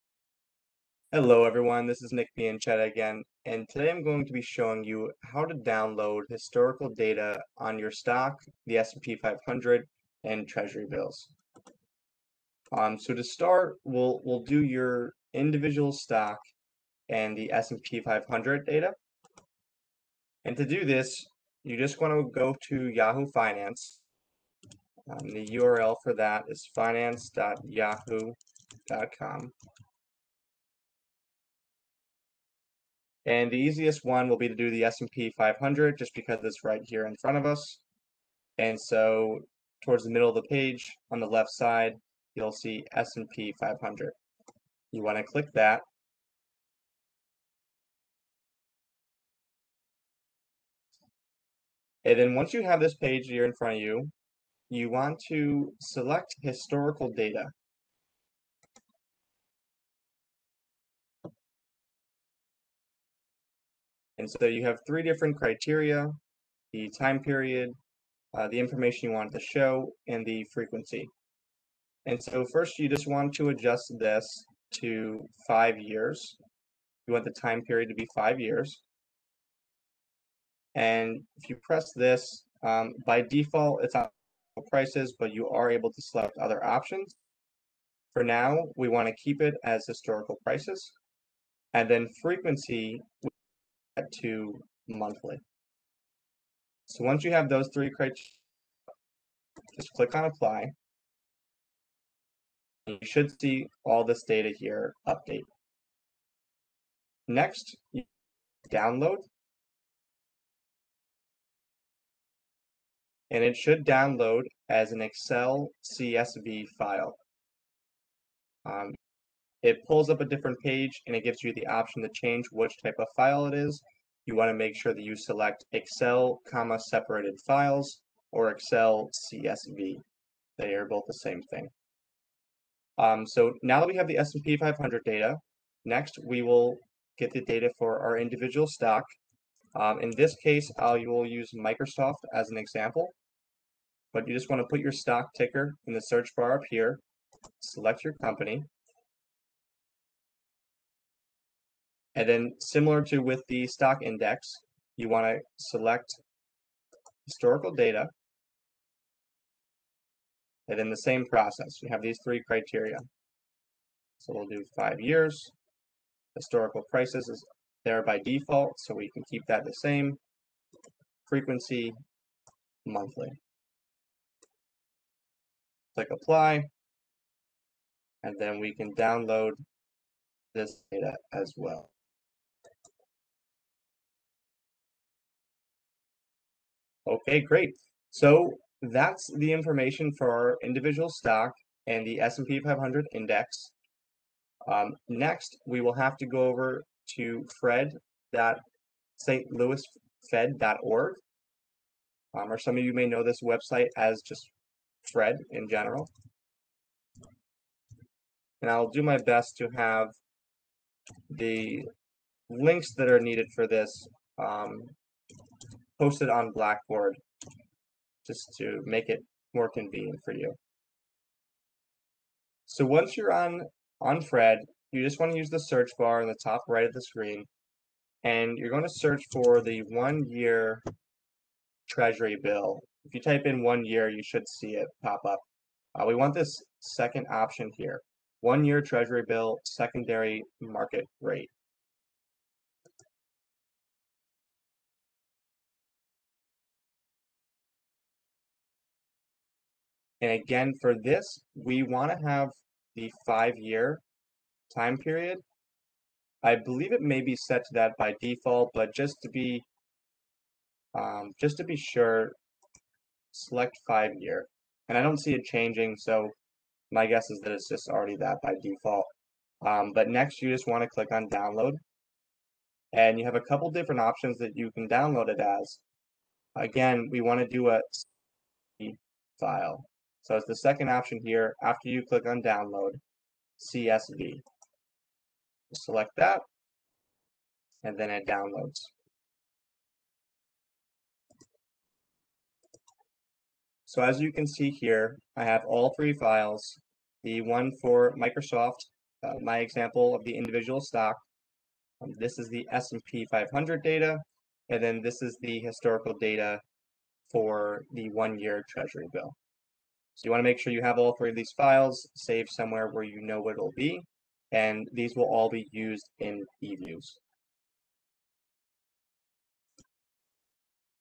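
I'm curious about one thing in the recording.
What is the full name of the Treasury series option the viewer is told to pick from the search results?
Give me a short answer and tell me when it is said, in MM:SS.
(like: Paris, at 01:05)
One-year Treasury bill secondary market rate, at 03:58.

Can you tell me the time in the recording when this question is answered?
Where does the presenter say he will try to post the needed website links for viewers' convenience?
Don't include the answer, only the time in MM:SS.
03:36.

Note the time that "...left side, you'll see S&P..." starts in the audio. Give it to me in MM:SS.
00:41.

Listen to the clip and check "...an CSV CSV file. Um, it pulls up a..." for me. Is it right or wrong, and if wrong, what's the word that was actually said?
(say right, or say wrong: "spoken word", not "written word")
wrong: "Excel", not "CSV".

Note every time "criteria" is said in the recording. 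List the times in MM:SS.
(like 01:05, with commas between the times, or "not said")
01:05, 01:37, 02:42.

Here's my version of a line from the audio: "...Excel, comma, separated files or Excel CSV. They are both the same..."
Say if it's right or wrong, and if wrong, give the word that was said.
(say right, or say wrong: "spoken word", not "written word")
right.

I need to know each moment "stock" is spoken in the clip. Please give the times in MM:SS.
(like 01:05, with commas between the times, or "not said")
00:07, 00:15, 02:18, 02:24, 02:33, 03:11, 05:00.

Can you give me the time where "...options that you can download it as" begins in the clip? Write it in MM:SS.
04:34.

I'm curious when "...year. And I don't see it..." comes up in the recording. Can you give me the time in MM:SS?
04:24.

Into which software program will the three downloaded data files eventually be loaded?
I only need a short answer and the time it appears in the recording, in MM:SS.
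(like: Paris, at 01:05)
eViews, at 05:16.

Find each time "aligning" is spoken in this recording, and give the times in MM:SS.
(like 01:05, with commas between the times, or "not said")
not said.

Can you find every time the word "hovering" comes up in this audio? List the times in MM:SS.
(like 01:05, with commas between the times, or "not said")
not said.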